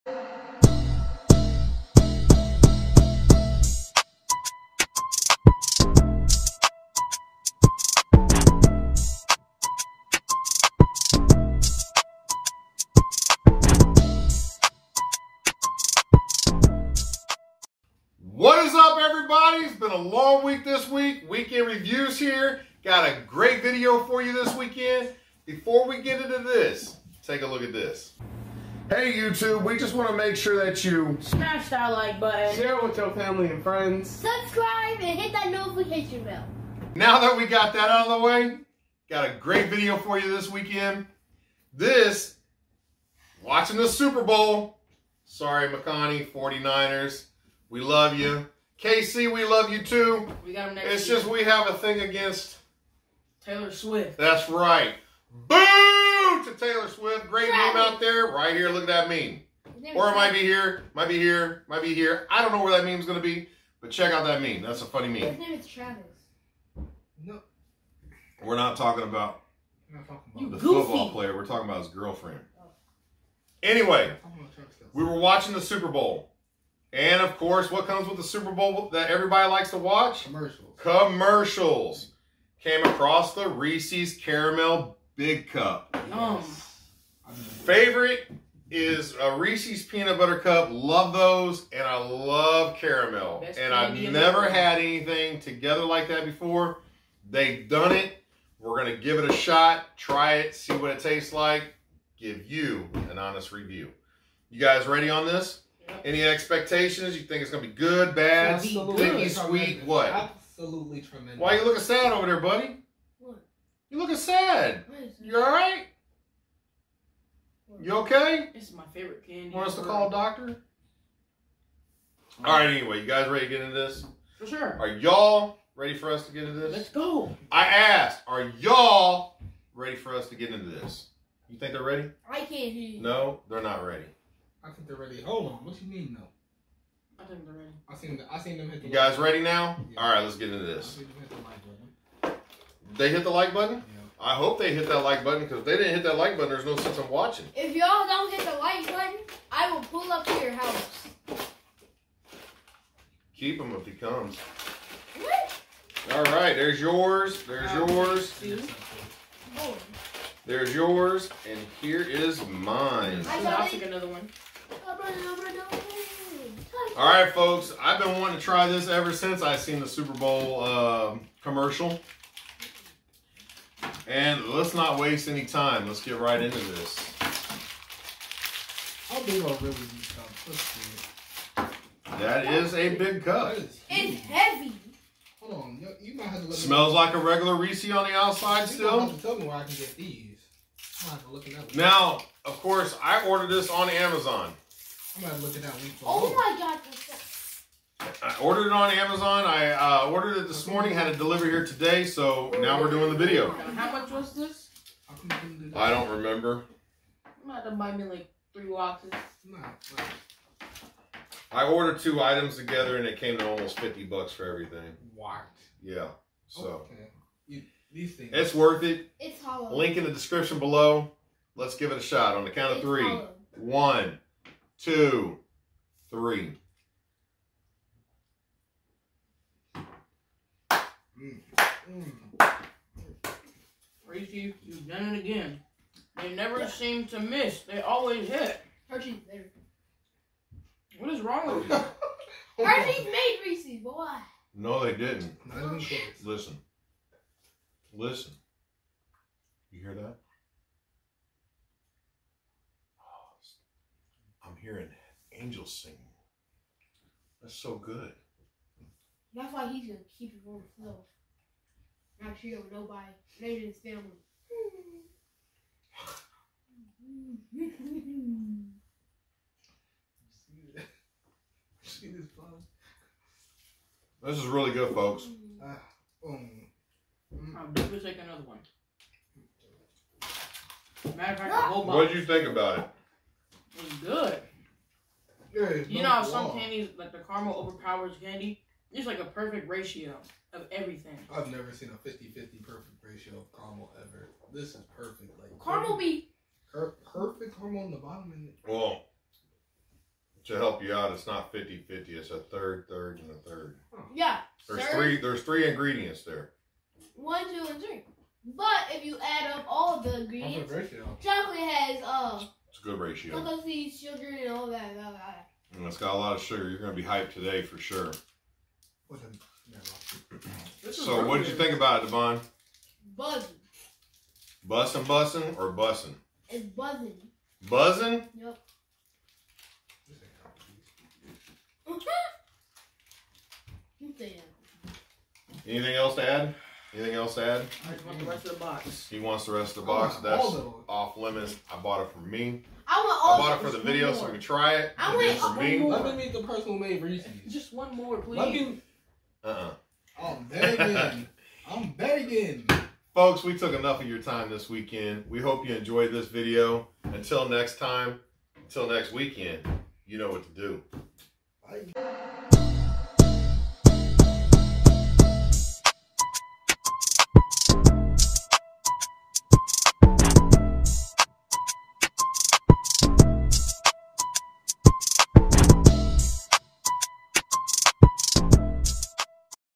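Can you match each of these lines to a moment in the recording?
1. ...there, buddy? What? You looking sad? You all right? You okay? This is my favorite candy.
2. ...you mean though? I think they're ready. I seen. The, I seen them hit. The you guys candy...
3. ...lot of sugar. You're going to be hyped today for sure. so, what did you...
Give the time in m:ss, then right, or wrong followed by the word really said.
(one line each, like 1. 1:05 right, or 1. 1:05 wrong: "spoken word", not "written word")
1. 1:52 right
2. 2:15 wrong: "ready", not "candy"
3. 5:16 right.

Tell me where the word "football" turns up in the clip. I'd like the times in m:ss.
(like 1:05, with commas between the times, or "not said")
1:10.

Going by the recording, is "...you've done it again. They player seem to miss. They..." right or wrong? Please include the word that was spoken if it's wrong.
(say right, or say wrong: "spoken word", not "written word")
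wrong: "never", not "player".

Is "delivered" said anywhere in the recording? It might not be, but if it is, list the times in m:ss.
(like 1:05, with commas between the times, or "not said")
3:21.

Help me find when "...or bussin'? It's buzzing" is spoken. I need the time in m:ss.
5:25.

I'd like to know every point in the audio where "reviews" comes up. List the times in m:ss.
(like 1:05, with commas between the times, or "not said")
0:21, 1:43.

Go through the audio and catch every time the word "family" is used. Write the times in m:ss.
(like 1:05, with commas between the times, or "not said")
0:33, 4:23.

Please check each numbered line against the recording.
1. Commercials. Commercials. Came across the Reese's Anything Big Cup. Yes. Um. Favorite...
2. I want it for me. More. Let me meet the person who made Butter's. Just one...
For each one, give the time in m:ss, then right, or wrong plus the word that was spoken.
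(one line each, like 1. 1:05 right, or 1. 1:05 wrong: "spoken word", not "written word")
1. 1:20 wrong: "Caramel", not "Anything"
2. 5:44 wrong: "Reese", not "Butter".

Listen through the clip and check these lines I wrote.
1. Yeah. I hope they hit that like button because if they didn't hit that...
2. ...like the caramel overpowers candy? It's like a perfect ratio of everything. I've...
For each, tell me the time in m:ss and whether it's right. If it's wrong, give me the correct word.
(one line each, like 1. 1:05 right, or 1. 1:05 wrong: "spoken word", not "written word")
1. 2:23 right
2. 4:46 right.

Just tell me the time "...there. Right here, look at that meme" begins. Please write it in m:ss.
0:57.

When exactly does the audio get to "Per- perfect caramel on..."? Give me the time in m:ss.
4:56.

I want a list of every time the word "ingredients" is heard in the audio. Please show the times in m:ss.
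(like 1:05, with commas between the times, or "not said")
5:05, 5:10.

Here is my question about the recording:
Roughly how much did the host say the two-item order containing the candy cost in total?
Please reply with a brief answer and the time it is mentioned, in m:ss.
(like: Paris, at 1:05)
almost 50 bucks, at 3:33.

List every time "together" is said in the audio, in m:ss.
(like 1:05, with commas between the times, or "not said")
1:35, 3:32.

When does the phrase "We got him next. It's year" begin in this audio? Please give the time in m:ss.
0:50.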